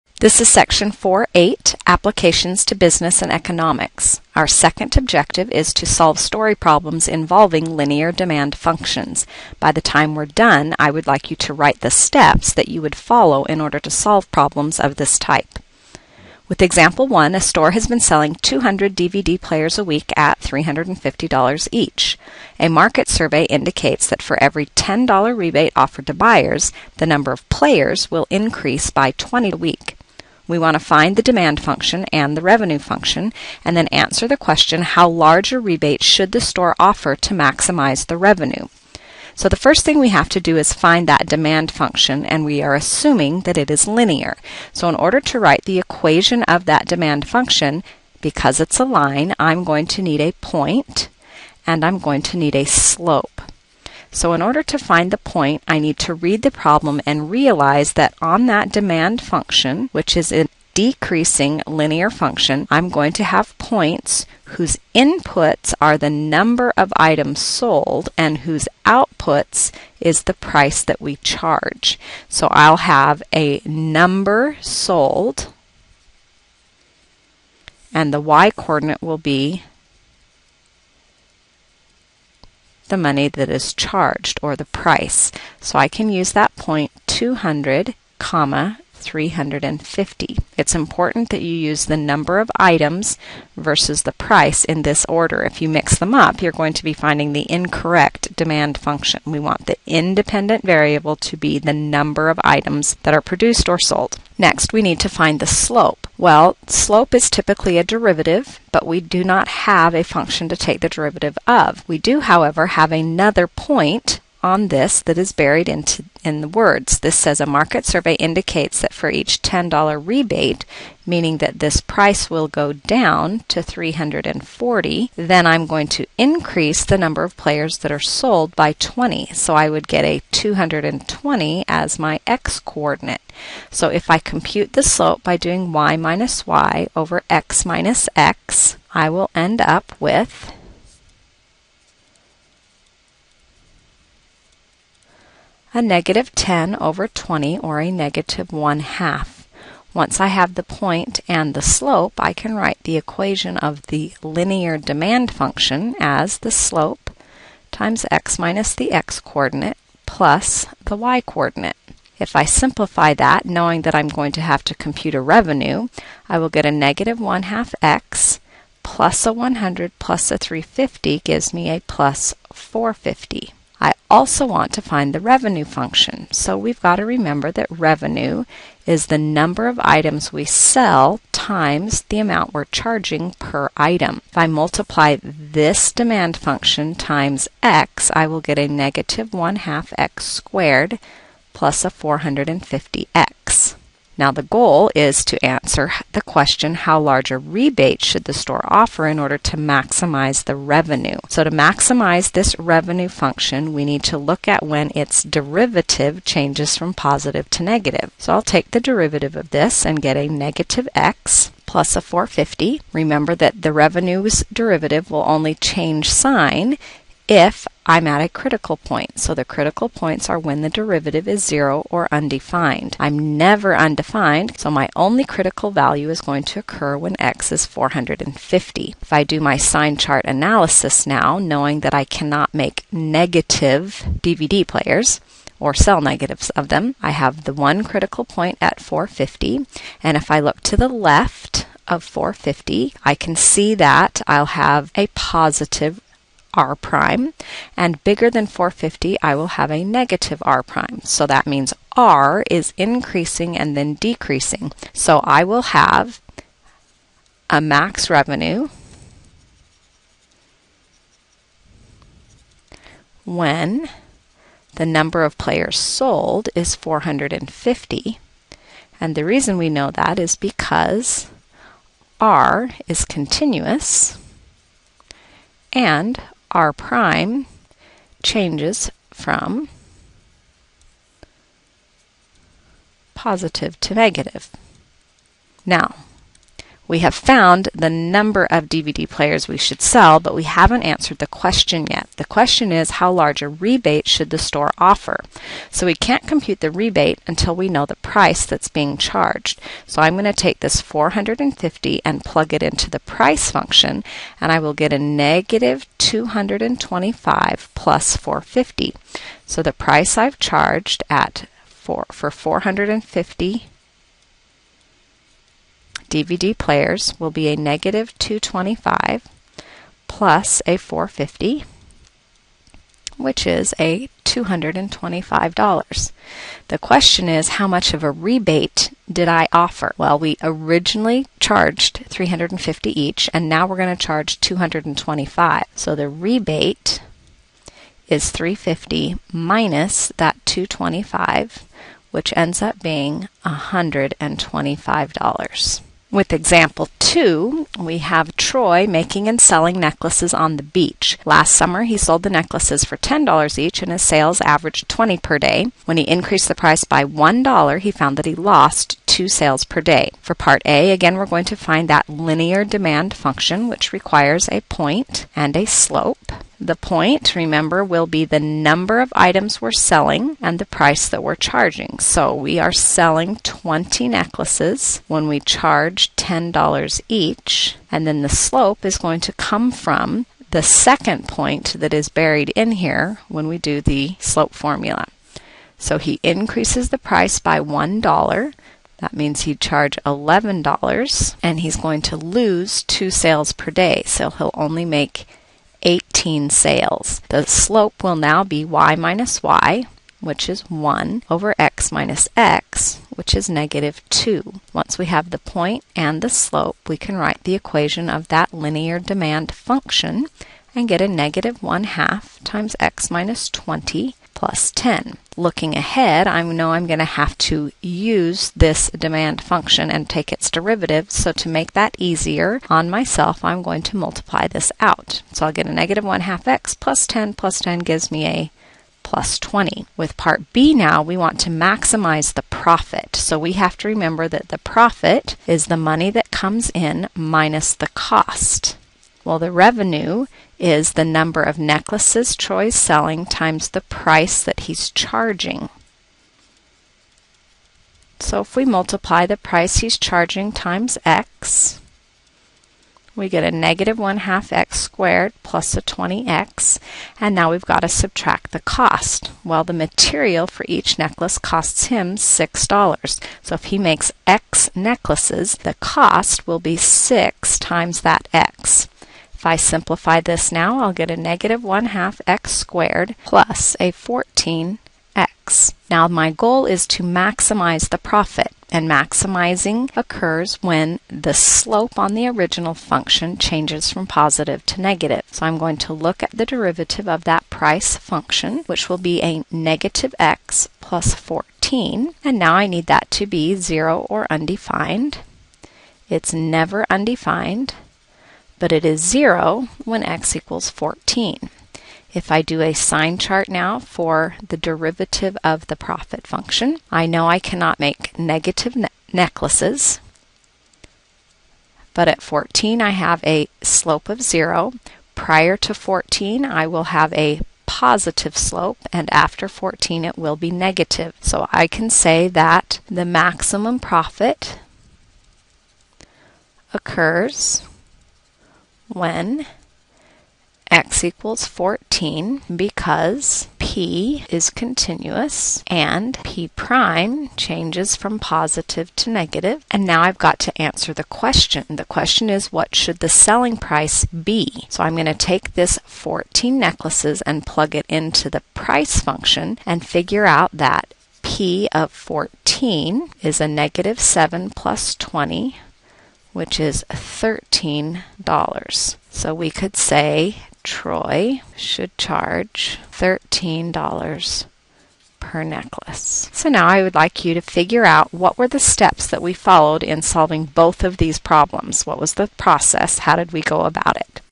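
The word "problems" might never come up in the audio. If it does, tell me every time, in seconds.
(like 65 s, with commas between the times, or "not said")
6 s, 14 s, 56 s, 571 s.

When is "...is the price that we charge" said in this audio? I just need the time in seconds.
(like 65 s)
70 s.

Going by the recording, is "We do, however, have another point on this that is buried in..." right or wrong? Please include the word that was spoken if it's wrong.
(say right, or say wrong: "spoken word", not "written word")
right.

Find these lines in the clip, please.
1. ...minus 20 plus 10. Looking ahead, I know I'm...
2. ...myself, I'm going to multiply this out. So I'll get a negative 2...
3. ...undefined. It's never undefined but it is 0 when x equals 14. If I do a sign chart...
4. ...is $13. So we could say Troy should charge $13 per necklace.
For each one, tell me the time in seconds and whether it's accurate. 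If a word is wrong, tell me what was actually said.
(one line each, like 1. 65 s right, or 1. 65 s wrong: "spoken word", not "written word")
1. 413 s right
2. 422 s wrong: "1", not "2"
3. 494 s right
4. 556 s right.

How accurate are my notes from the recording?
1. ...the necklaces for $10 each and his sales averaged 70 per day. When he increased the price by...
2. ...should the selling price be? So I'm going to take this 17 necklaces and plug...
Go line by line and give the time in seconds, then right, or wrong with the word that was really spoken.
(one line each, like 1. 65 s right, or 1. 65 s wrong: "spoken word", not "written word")
1. 352 s wrong: "20", not "70"
2. 542 s wrong: "14", not "17".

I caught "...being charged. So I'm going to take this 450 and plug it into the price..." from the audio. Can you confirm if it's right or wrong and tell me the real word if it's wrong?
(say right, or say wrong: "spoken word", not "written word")
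right.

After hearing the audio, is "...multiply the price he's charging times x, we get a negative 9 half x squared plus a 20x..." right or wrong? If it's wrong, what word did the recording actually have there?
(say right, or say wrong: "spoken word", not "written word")
wrong: "1", not "9".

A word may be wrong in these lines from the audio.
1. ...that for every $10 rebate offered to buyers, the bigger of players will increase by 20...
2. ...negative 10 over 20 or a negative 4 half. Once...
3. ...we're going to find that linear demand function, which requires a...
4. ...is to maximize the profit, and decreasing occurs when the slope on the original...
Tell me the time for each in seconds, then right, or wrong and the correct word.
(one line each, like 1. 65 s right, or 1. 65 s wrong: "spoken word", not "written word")
1. 24 s wrong: "number", not "bigger"
2. 145 s wrong: "1", not "4"
3. 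361 s right
4. 476 s wrong: "maximizing", not "decreasing".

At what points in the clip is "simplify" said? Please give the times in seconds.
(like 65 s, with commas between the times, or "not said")
162 s, 469 s.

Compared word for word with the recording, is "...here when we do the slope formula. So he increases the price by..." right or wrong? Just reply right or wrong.
right.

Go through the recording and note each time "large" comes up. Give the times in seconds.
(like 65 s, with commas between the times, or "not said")
35 s, 196 s, 293 s.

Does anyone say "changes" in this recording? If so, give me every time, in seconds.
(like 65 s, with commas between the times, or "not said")
206 s, 215 s, 278 s, 483 s, 537 s.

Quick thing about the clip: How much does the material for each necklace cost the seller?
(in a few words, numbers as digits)
$6.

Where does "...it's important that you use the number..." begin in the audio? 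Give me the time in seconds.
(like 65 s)
90 s.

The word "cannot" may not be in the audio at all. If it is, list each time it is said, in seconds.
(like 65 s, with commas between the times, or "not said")
232 s, 507 s.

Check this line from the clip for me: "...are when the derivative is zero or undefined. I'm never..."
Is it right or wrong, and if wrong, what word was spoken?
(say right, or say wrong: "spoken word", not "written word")
right.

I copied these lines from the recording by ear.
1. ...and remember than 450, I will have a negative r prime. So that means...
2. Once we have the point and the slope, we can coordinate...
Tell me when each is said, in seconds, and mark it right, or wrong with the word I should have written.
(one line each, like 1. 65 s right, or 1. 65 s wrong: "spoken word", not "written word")
1. 247 s wrong: "bigger", not "remember"
2. 404 s wrong: "write", not "coordinate".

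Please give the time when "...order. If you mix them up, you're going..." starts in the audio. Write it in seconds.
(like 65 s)
95 s.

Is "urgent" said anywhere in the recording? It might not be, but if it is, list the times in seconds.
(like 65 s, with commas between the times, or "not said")
not said.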